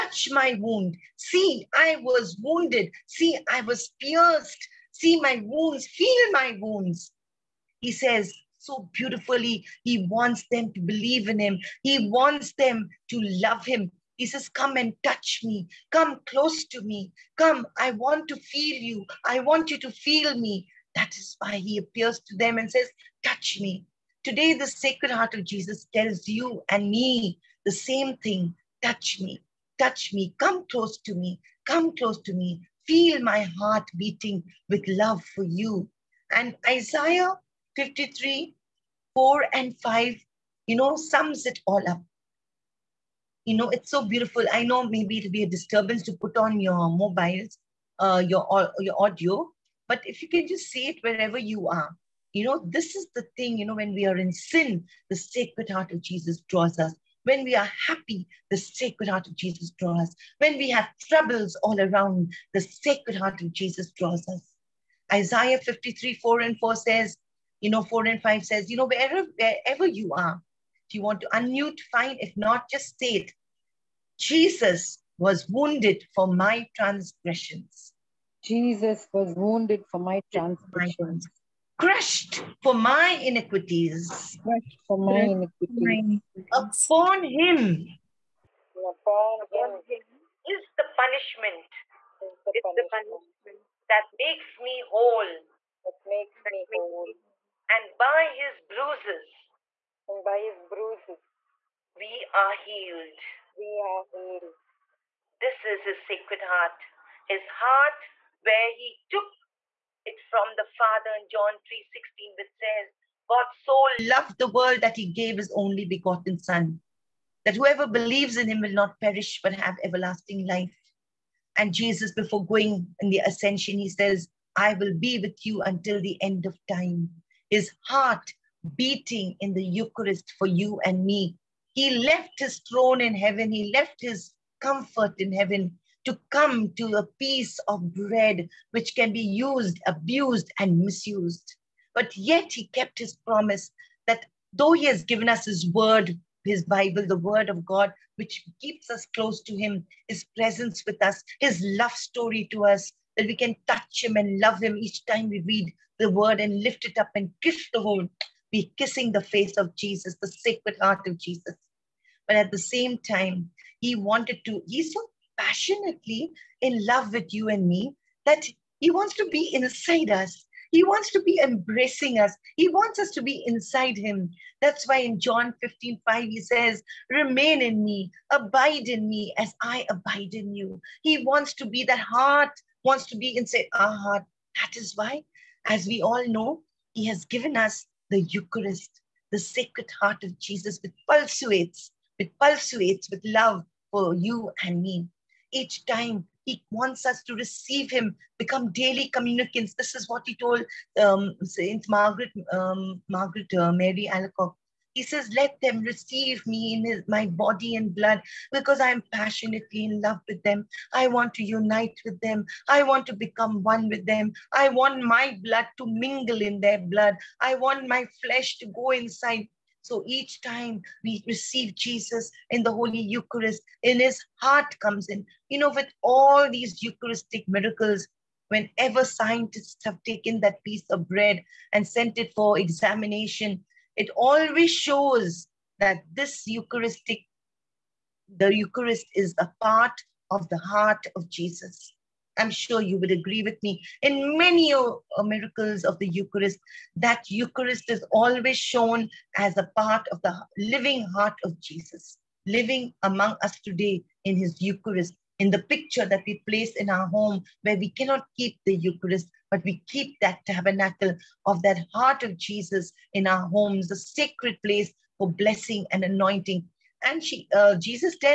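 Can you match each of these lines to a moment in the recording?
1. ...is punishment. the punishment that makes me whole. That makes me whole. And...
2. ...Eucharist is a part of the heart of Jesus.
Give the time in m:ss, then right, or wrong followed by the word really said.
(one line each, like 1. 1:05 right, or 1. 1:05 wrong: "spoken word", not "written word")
1. 1:32 right
2. 3:58 right.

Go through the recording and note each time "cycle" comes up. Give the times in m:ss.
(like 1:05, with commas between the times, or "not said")
not said.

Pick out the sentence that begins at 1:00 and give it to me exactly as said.
When we have troubles all around, the sacred heart of Jesus draws us.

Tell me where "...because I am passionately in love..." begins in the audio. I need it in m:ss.
3:28.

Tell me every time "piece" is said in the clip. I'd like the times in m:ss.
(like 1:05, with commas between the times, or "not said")
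2:17, 3:50.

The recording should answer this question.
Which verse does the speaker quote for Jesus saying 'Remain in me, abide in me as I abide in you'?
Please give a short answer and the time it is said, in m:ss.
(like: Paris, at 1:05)
John 15:5, at 2:55.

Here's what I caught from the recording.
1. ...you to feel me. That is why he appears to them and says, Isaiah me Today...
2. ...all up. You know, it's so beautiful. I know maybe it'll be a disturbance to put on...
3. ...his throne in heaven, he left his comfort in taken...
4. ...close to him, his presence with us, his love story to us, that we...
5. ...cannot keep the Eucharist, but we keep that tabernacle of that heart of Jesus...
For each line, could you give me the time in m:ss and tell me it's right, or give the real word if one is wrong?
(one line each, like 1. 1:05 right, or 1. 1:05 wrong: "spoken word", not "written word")
1. 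0:19 wrong: "Touch", not "Isaiah"
2. 0:41 right
3. 2:12 wrong: "heaven", not "taken"
4. 2:29 right
5. 4:17 right.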